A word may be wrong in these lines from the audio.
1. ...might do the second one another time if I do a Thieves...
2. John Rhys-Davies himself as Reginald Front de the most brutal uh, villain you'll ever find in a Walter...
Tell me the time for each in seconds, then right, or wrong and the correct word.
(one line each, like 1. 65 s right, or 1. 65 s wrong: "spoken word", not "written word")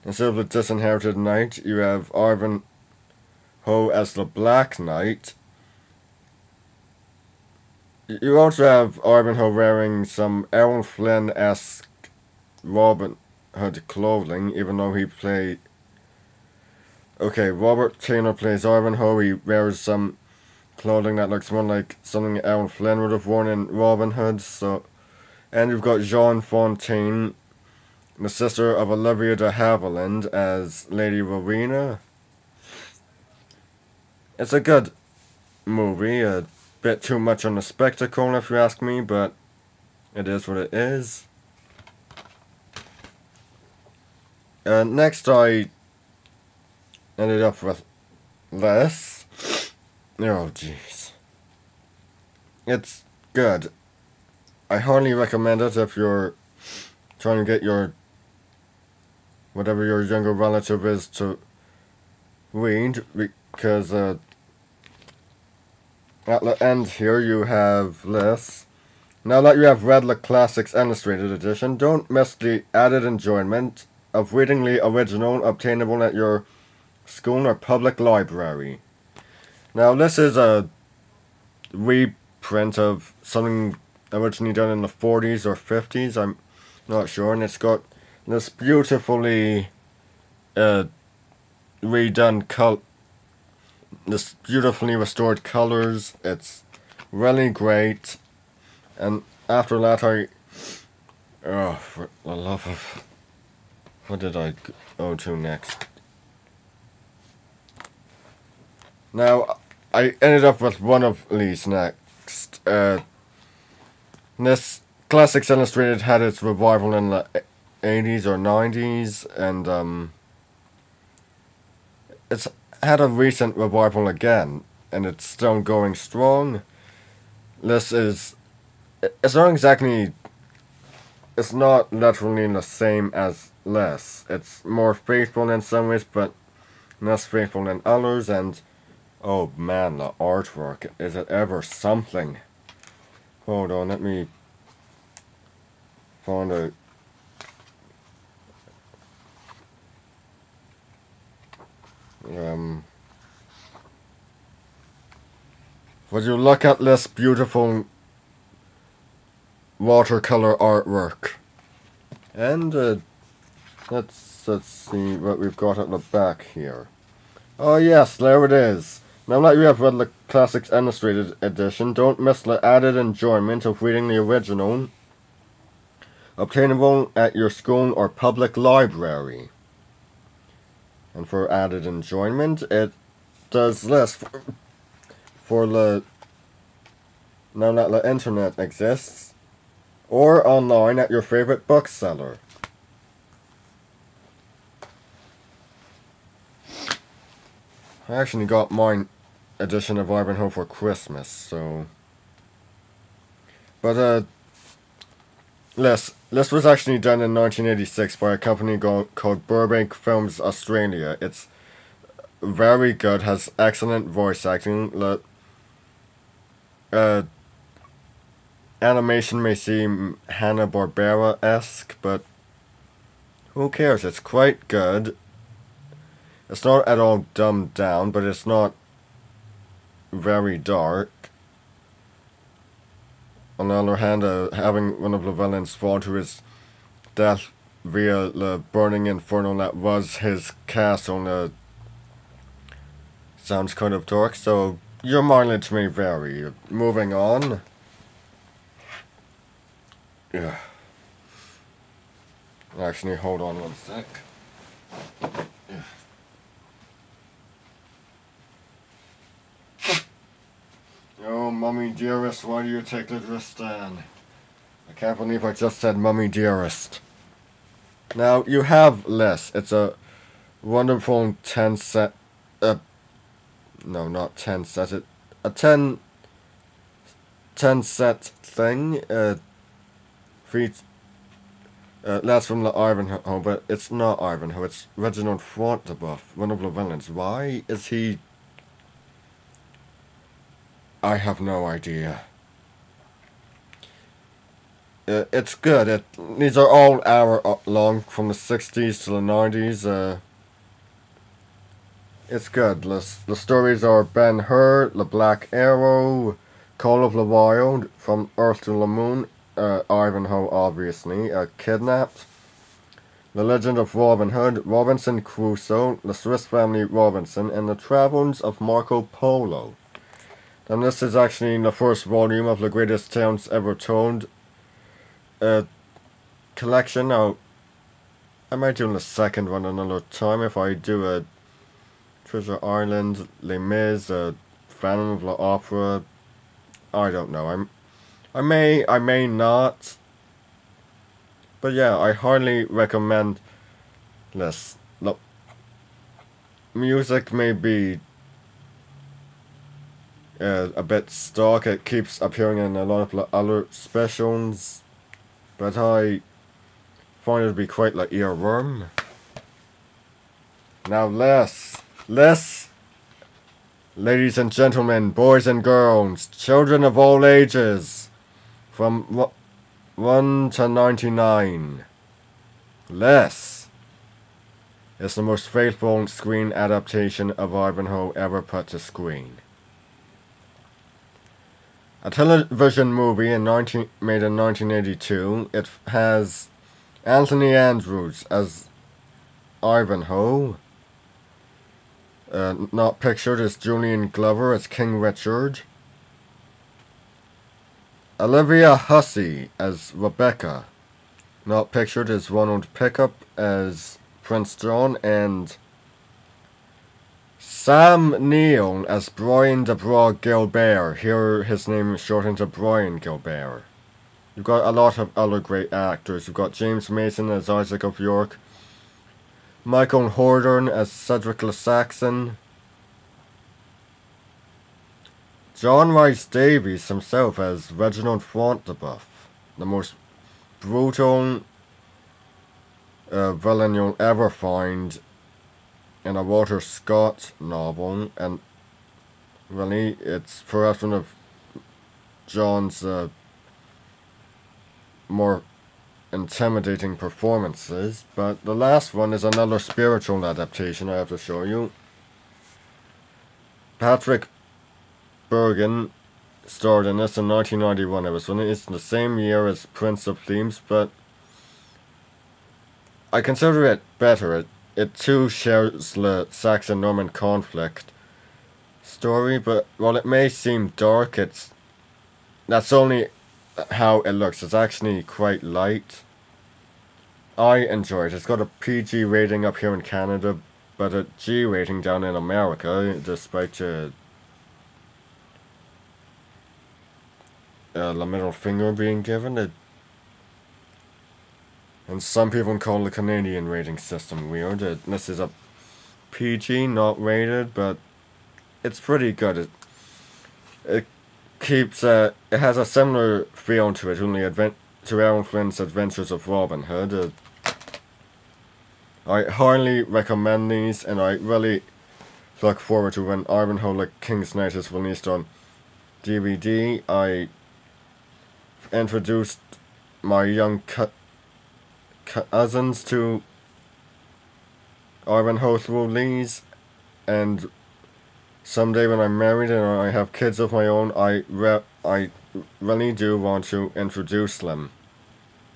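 1. 328 s wrong: "Treasure", not "Thieves"
2. 425 s right.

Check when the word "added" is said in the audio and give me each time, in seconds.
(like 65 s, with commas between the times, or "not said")
72 s, 172 s, 181 s.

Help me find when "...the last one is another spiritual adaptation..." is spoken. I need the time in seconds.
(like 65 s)
448 s.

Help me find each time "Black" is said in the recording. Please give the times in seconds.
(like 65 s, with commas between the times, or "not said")
4 s, 305 s.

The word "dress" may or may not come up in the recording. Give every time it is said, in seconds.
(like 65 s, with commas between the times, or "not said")
263 s.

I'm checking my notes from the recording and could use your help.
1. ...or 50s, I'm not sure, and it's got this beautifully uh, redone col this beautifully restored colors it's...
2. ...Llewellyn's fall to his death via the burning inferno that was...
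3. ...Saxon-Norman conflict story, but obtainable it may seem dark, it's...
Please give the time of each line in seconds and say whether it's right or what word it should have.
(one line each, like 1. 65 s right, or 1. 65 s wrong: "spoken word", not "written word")
1. 85 s right
2. 235 s right
3. 466 s wrong: "while", not "obtainable".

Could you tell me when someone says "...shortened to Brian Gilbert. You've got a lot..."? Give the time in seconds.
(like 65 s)
411 s.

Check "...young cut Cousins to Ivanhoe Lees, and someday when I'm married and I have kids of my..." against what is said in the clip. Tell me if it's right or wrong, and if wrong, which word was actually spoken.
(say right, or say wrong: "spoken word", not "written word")
right.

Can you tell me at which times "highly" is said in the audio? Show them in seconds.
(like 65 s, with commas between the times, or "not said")
342 s, 509 s.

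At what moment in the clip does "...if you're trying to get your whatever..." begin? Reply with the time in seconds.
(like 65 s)
55 s.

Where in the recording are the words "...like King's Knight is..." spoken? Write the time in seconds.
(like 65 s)
513 s.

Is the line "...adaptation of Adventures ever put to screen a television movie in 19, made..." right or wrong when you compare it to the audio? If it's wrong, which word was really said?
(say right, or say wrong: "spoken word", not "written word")
wrong: "Ivanhoe", not "Adventures".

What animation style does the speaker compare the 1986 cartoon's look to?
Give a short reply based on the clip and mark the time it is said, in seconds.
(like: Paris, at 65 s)
Hanna-Barbera, at 220 s.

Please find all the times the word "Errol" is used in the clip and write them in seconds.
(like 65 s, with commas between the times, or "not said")
10 s, 22 s, 505 s.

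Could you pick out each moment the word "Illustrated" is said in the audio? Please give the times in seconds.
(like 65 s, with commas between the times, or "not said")
70 s, 115 s, 170 s.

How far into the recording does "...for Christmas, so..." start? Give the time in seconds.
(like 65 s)
200 s.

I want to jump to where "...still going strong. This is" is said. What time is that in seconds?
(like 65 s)
125 s.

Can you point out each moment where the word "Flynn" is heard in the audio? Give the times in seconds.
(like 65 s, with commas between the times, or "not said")
10 s, 22 s, 505 s.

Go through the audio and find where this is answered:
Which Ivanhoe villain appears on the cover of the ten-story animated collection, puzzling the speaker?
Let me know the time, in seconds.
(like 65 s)
284 s.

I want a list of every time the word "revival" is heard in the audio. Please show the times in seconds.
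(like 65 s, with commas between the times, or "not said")
116 s, 123 s.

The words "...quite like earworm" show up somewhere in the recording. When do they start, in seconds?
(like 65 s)
357 s.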